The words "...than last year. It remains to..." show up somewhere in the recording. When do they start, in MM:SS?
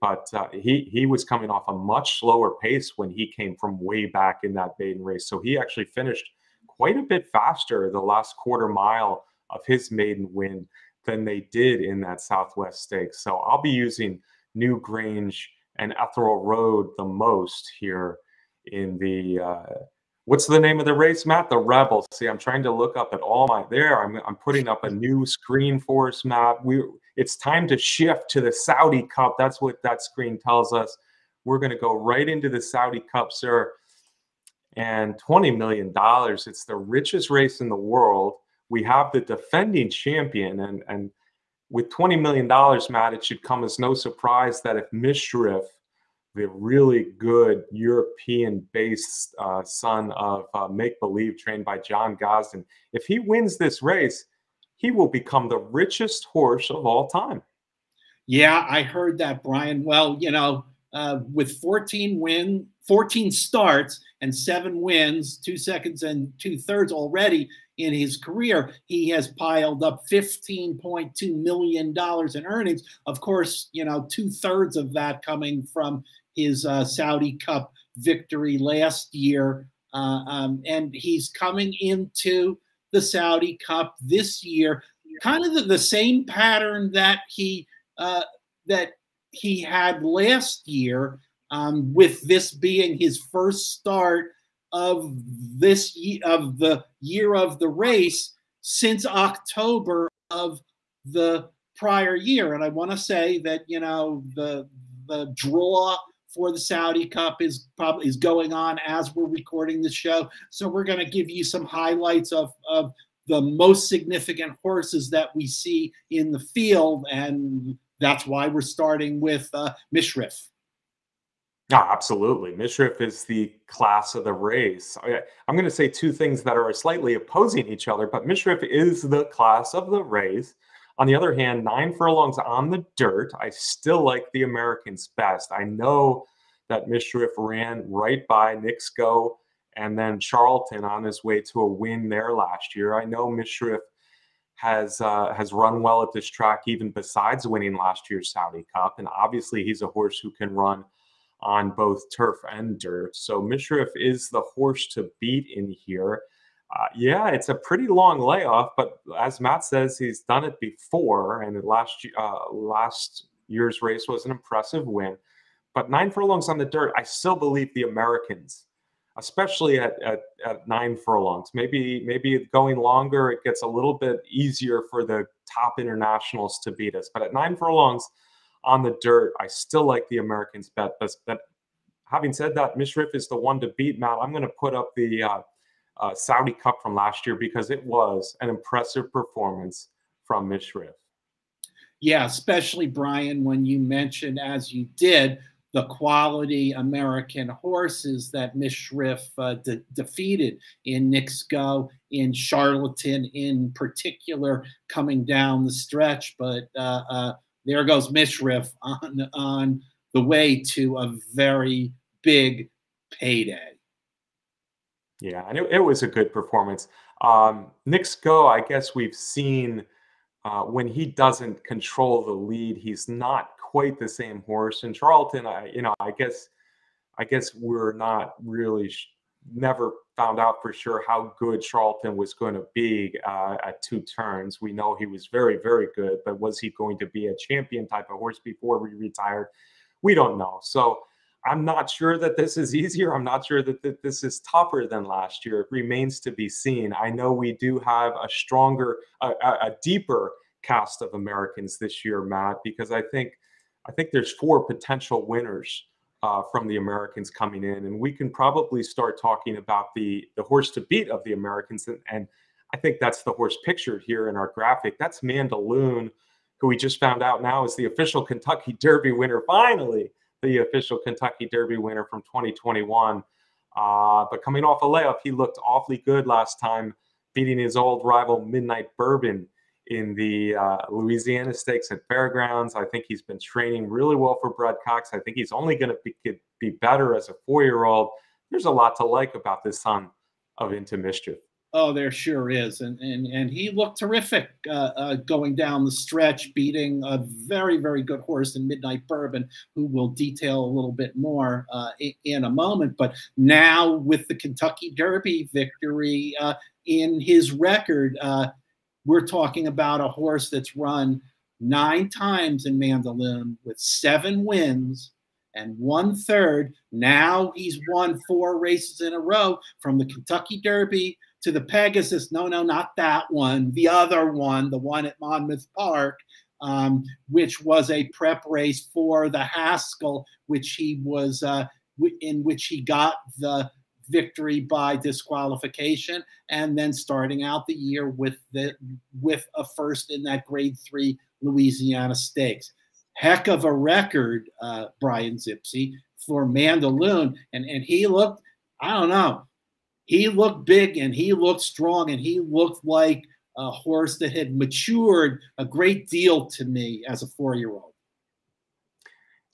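04:04.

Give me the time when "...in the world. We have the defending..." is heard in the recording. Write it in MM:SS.
00:37.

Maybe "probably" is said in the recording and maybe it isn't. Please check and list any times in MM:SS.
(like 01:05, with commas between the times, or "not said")
01:47, 04:18.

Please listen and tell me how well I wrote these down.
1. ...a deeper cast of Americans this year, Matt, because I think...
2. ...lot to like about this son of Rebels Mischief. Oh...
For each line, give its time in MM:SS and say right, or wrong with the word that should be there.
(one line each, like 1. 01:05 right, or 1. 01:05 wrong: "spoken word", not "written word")
1. 04:09 right
2. 04:48 wrong: "Into", not "Rebels".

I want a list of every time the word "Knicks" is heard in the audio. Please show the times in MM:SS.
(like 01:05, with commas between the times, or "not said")
02:18, 03:21.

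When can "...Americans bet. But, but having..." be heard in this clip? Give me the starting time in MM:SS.
03:00.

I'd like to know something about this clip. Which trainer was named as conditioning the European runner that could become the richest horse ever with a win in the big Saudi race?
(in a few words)
John Gosden.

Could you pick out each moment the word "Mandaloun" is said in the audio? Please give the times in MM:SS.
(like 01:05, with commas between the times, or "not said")
04:25, 05:12, 05:46.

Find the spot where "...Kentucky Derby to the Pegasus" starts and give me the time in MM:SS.
05:20.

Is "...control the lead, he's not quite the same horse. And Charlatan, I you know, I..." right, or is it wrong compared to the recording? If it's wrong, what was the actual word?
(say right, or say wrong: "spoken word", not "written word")
right.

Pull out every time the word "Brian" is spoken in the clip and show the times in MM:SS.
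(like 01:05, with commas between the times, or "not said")
00:59, 03:12, 05:44.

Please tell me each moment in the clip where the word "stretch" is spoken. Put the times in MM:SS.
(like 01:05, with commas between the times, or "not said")
03:25, 04:55.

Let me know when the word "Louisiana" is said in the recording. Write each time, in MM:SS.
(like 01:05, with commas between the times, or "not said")
04:40, 05:41.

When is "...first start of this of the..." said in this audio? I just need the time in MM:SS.
01:33.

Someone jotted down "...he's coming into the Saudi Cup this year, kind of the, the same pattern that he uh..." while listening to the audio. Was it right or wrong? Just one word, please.
right.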